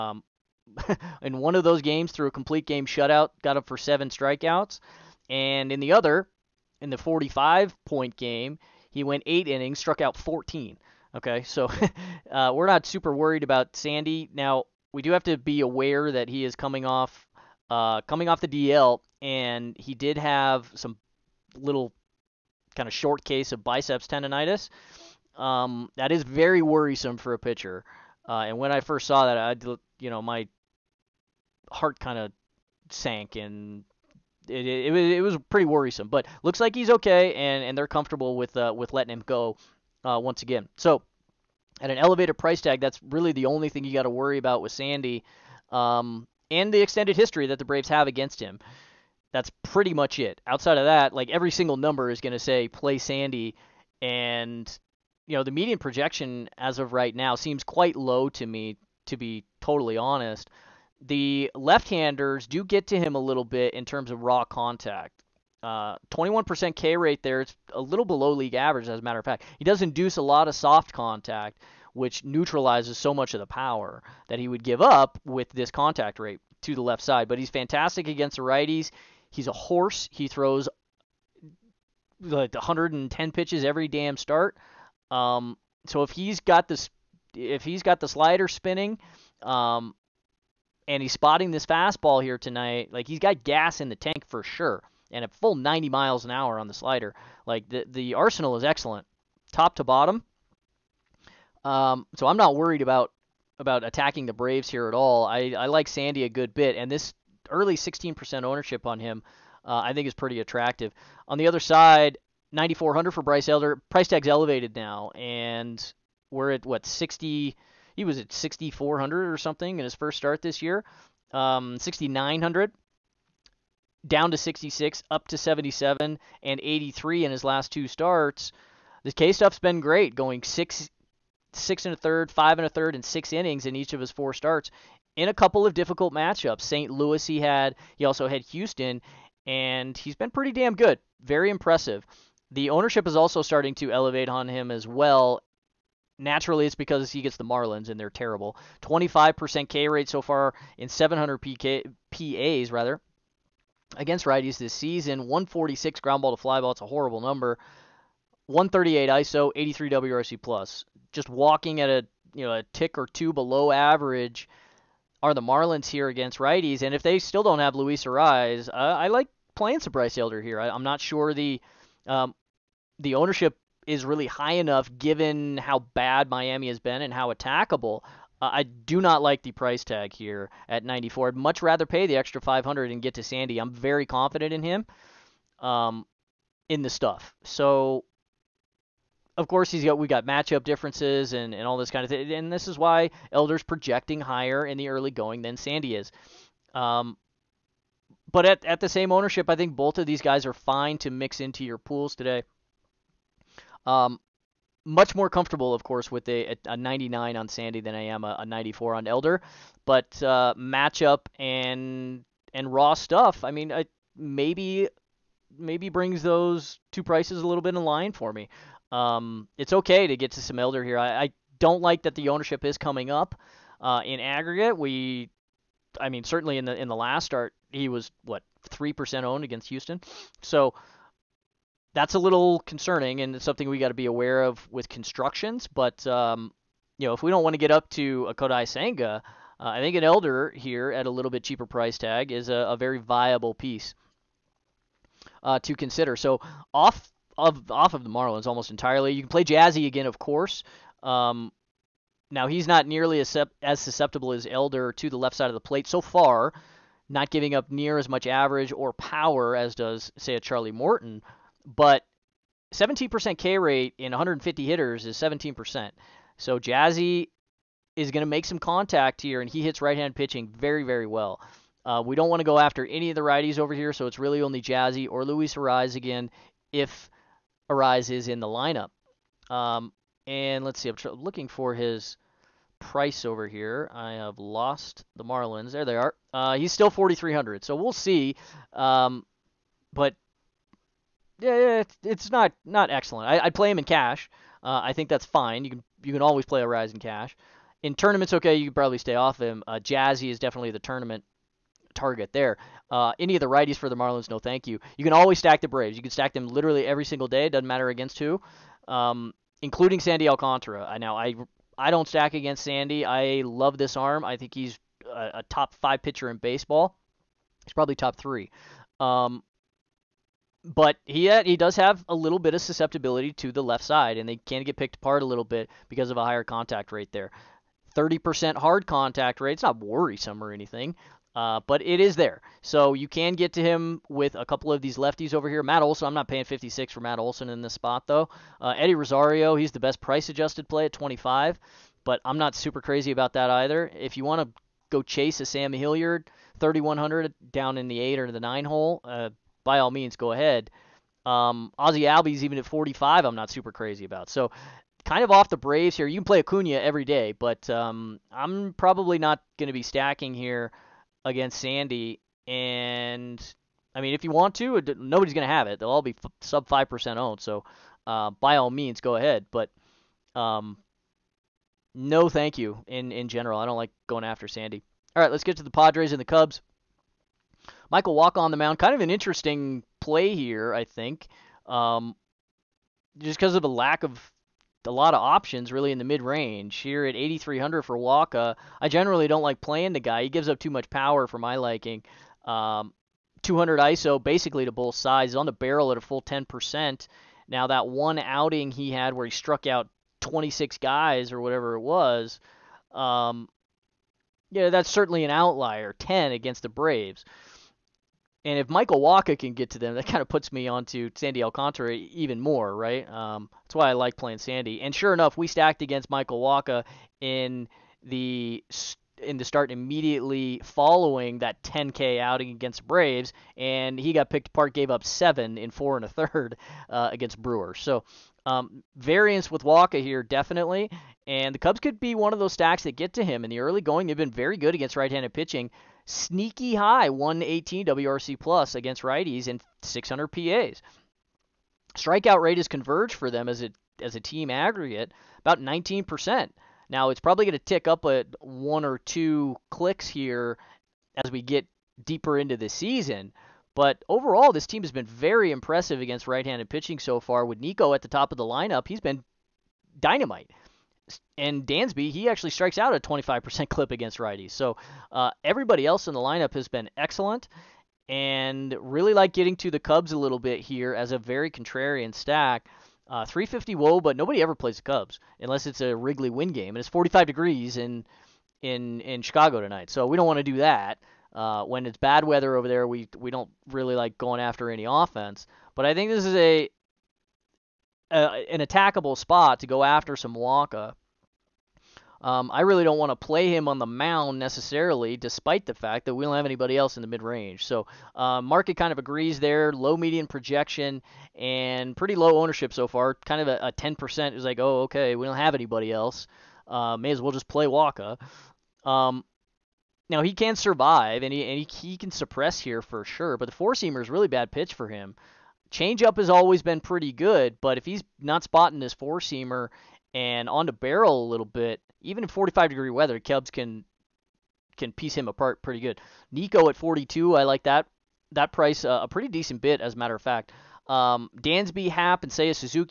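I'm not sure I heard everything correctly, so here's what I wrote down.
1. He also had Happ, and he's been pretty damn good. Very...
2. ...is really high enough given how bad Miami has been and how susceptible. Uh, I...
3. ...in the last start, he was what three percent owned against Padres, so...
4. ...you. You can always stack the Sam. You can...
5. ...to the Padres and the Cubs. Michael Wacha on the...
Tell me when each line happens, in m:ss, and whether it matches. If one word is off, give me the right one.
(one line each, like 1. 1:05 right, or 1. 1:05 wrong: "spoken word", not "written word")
1. 2:17 wrong: "Houston", not "Happ"
2. 2:53 wrong: "attackable", not "susceptible"
3. 3:46 wrong: "Houston", not "Padres"
4. 5:04 wrong: "Braves", not "Sam"
5. 6:15 right.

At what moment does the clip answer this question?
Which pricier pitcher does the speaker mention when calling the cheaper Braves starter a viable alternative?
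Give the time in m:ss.
3:58.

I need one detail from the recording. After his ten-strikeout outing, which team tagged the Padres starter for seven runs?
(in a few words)
Brewers.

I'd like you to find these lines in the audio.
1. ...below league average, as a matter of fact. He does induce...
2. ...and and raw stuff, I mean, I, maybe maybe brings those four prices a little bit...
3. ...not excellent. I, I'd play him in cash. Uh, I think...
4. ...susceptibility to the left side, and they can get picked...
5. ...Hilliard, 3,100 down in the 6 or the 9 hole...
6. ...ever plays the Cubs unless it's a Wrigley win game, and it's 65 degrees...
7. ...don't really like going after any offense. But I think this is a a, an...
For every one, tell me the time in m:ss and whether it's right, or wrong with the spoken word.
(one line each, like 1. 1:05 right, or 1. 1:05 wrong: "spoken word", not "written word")
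1. 1:08 right
2. 3:31 wrong: "two", not "four"
3. 4:52 right
4. 5:22 right
5. 5:45 wrong: "8", not "6"
6. 7:54 wrong: "45", not "65"
7. 8:03 right.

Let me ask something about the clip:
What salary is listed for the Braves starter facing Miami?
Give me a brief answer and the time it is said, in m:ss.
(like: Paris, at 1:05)
9400, at 1:52.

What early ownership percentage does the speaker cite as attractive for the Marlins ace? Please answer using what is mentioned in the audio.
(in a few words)
16%.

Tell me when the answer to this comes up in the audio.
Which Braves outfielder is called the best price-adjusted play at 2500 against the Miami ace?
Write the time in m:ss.
5:38.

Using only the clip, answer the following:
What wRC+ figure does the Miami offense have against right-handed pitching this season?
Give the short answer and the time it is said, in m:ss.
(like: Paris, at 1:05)
83, at 2:39.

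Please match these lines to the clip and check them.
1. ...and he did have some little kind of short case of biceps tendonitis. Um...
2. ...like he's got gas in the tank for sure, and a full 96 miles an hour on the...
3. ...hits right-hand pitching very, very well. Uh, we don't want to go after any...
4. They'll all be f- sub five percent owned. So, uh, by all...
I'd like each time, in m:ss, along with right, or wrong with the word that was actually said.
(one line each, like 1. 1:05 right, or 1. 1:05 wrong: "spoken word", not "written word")
1. 0:19 right
2. 1:32 wrong: "90", not "96"
3. 4:29 right
4. 6:05 right.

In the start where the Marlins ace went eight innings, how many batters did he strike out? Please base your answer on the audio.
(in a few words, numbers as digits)
14.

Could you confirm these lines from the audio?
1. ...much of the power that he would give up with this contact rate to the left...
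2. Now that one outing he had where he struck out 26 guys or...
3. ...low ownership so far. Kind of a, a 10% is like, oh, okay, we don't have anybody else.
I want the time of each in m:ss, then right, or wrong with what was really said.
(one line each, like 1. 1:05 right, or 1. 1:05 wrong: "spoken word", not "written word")
1. 1:13 right
2. 6:37 right
3. 8:22 right.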